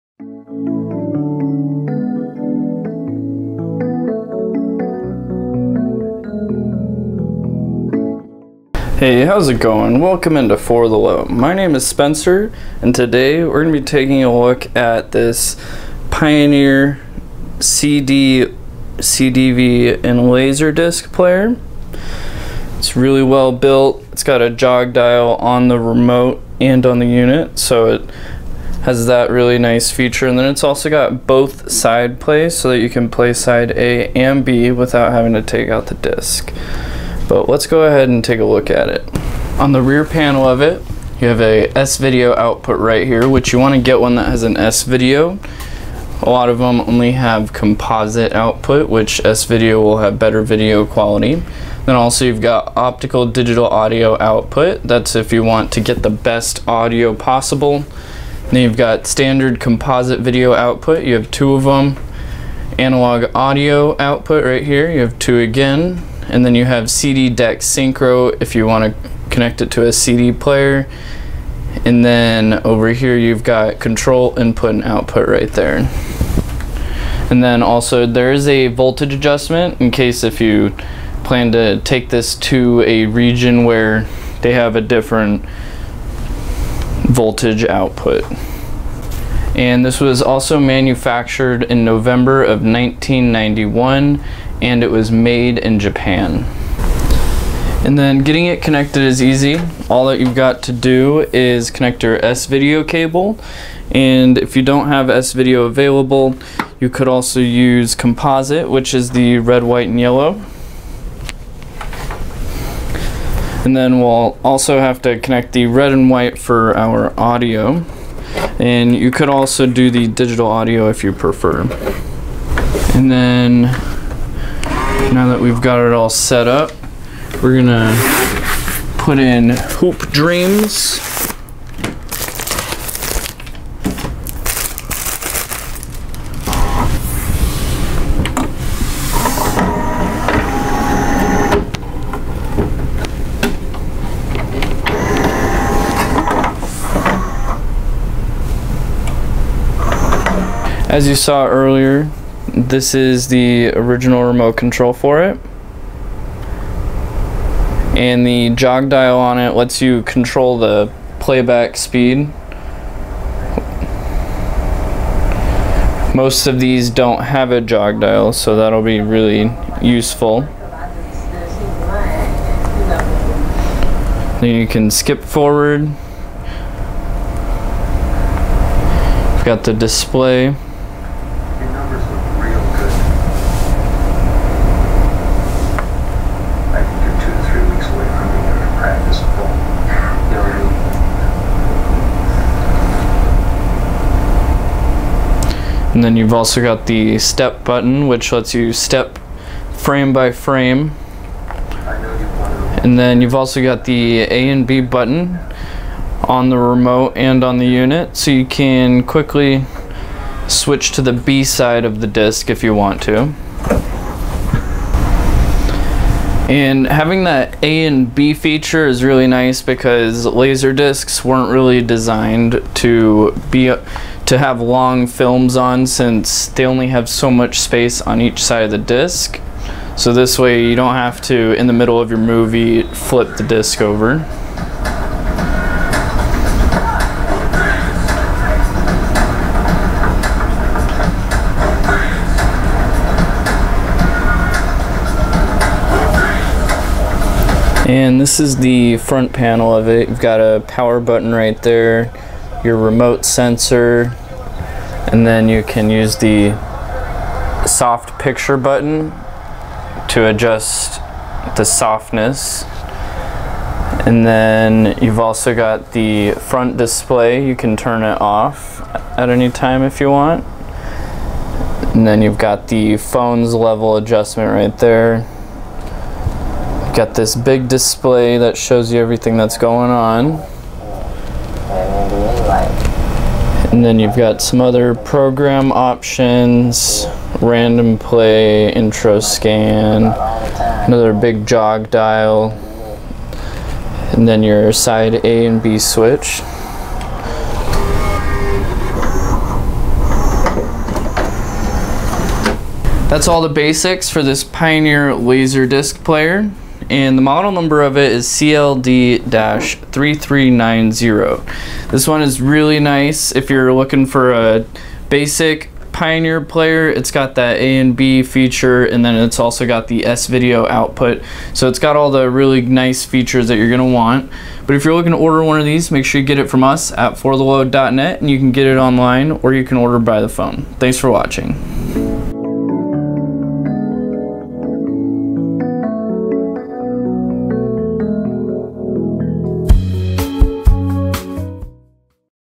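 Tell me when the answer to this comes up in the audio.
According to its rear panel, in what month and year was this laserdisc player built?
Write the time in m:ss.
1:31.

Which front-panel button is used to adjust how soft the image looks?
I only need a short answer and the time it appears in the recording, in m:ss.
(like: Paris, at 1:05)
soft picture, at 4:17.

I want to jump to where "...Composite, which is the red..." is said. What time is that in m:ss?
1:47.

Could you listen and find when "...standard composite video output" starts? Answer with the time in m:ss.
0:59.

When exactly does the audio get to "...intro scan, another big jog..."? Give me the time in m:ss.
4:48.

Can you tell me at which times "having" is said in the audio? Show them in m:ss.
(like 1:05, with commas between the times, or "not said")
0:35, 3:36.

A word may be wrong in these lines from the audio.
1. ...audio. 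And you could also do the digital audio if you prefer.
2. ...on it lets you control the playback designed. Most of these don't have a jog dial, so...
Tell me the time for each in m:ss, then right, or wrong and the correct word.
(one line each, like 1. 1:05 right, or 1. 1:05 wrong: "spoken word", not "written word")
1. 1:57 right
2. 2:39 wrong: "speed", not "designed".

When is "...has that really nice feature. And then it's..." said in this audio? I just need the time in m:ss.
0:28.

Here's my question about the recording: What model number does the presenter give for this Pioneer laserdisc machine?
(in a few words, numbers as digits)
CLD-3390.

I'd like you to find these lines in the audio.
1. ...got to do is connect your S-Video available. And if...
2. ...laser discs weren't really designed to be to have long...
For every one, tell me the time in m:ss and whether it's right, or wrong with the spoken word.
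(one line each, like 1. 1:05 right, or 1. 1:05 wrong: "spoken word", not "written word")
1. 1:40 wrong: "cable", not "available"
2. 3:40 right.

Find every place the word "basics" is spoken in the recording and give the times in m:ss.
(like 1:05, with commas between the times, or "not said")
5:03, 5:15.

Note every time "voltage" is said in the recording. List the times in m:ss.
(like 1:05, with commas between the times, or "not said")
1:18, 1:27.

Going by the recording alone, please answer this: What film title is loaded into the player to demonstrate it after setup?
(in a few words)
Hoop Dreams.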